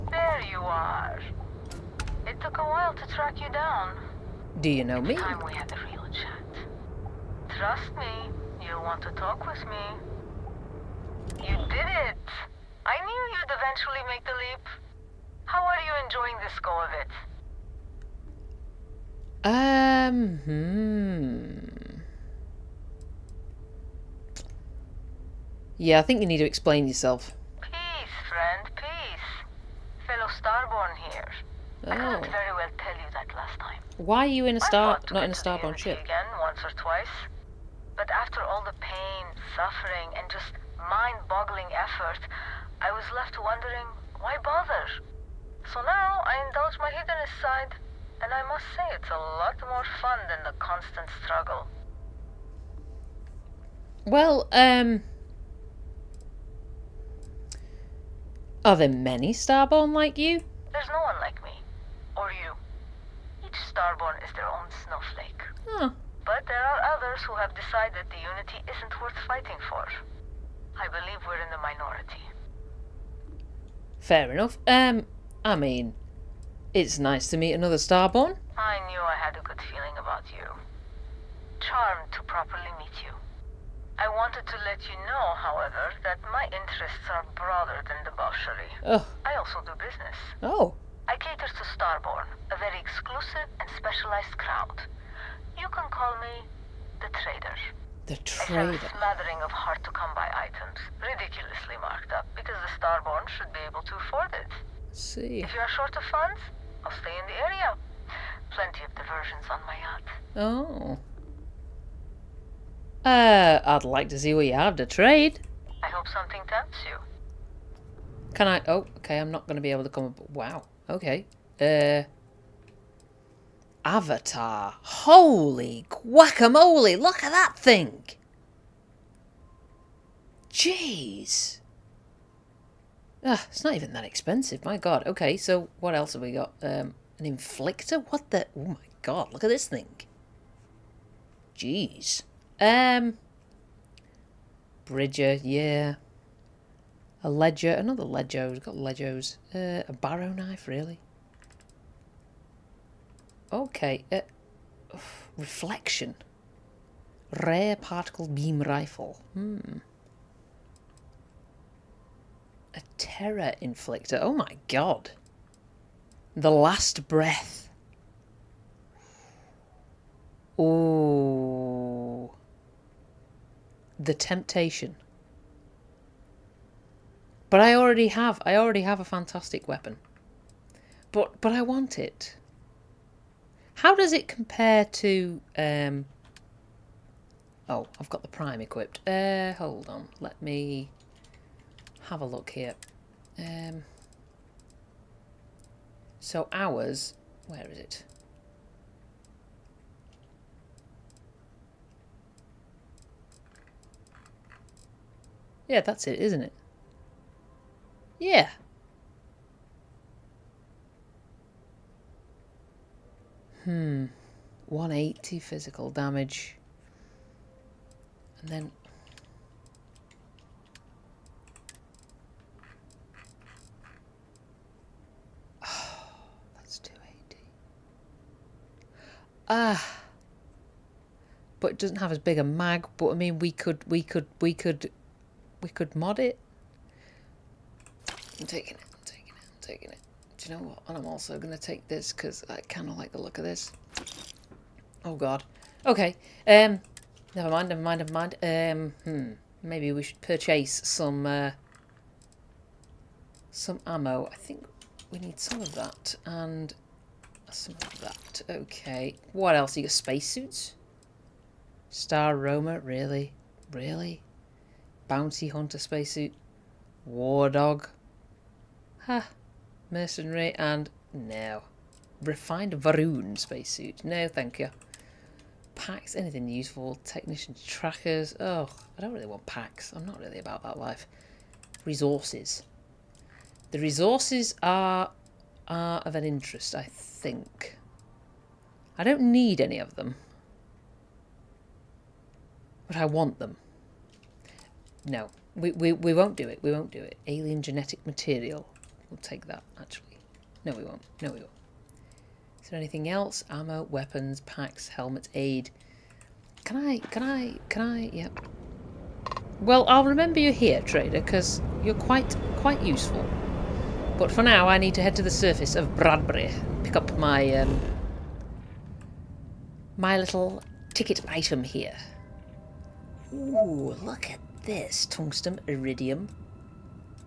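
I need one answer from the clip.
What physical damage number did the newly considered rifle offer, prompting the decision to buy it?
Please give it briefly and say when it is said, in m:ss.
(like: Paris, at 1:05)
280, at 3:46.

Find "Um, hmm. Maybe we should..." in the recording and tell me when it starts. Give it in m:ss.
4:08.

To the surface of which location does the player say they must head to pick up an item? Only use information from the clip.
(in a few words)
Bradbury.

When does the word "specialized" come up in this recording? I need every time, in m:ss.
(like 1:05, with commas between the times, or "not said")
1:33.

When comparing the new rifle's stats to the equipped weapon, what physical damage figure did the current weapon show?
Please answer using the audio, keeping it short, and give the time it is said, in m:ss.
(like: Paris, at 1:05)
180, at 3:34.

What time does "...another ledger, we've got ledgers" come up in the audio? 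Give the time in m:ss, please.
2:27.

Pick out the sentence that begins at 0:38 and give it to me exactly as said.
But after all the pain, suffering, and just mind-boggling effort, I was left wondering, why bother?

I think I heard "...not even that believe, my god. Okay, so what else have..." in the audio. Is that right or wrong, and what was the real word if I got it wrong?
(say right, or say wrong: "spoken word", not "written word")
wrong: "expensive", not "believe".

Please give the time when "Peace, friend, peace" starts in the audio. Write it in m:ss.
0:27.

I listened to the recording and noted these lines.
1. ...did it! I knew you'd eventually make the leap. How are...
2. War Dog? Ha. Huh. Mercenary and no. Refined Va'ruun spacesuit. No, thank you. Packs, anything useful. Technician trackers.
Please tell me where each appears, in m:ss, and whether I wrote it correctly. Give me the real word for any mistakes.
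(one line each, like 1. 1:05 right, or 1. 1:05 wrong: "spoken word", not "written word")
1. 0:11 right
2. 4:27 right.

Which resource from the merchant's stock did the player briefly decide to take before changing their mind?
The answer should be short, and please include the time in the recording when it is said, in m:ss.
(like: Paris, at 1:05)
Alien genetic material, at 4:57.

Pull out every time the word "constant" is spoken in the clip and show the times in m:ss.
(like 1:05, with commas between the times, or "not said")
0:50.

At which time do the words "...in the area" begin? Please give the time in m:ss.
1:47.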